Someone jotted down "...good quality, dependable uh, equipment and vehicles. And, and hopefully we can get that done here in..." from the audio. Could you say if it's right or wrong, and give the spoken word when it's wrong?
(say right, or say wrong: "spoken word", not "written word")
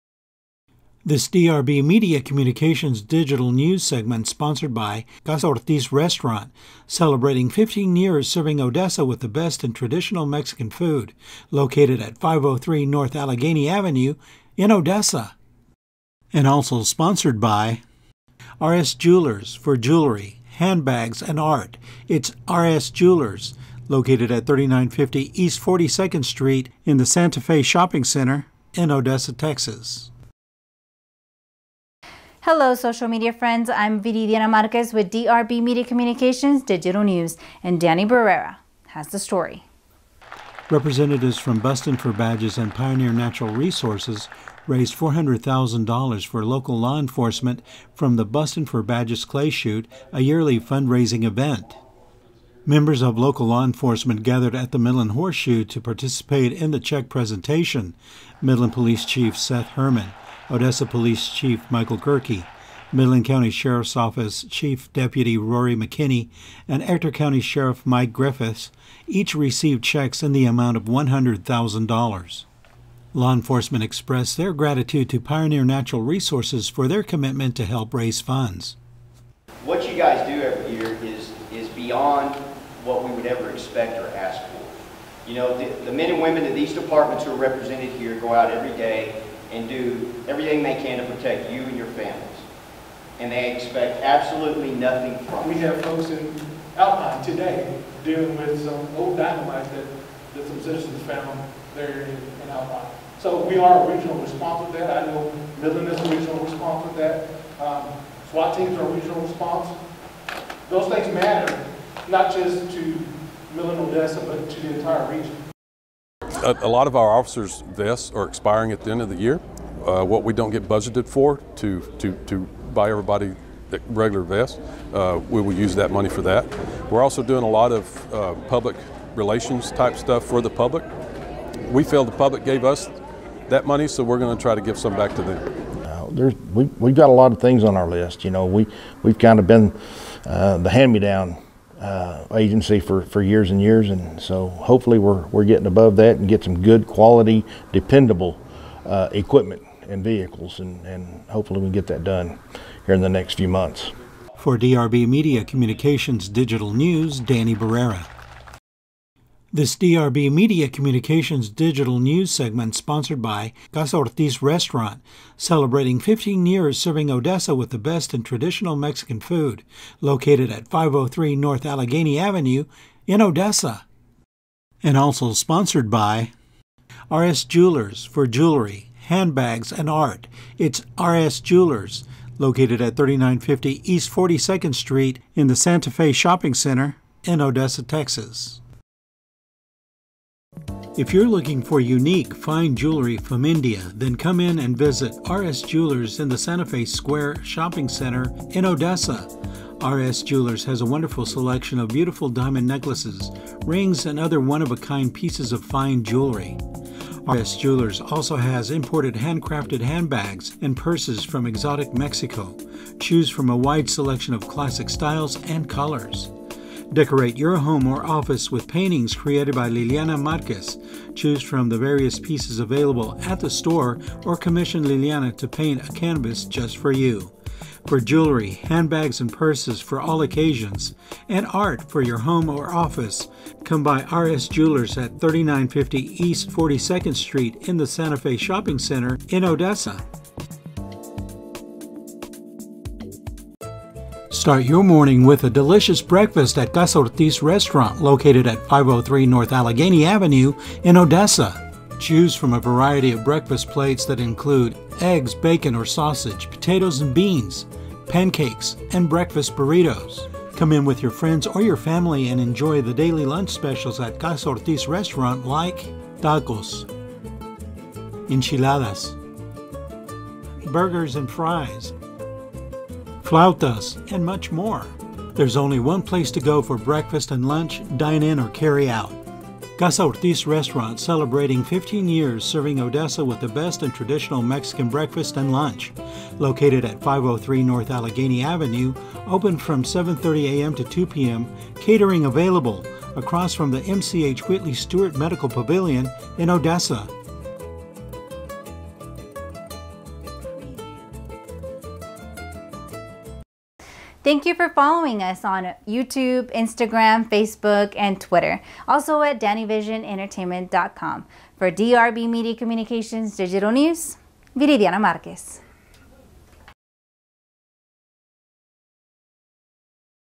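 right.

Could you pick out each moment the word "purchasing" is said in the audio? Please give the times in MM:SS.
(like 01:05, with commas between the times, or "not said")
not said.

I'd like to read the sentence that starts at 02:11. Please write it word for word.
We feel the public gave us that money, so we're going to try to give some back to them.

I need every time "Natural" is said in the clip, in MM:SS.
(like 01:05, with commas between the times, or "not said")
00:43, 01:15.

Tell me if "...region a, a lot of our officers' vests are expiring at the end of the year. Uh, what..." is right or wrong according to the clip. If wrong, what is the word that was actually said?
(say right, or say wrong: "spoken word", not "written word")
right.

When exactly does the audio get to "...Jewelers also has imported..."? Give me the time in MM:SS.
03:27.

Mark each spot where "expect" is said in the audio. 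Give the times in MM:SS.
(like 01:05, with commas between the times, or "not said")
01:23, 01:33.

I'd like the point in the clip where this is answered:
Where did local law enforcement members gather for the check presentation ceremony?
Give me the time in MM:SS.
00:54.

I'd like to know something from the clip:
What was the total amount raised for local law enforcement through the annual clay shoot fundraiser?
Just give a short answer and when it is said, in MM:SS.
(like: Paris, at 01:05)
$400,000, at 00:44.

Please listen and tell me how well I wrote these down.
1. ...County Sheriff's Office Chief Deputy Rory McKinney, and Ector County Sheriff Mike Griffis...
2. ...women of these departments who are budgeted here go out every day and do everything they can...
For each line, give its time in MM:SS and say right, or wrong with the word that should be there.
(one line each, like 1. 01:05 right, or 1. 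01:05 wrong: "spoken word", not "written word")
1. 01:03 right
2. 01:26 wrong: "represented", not "budgeted".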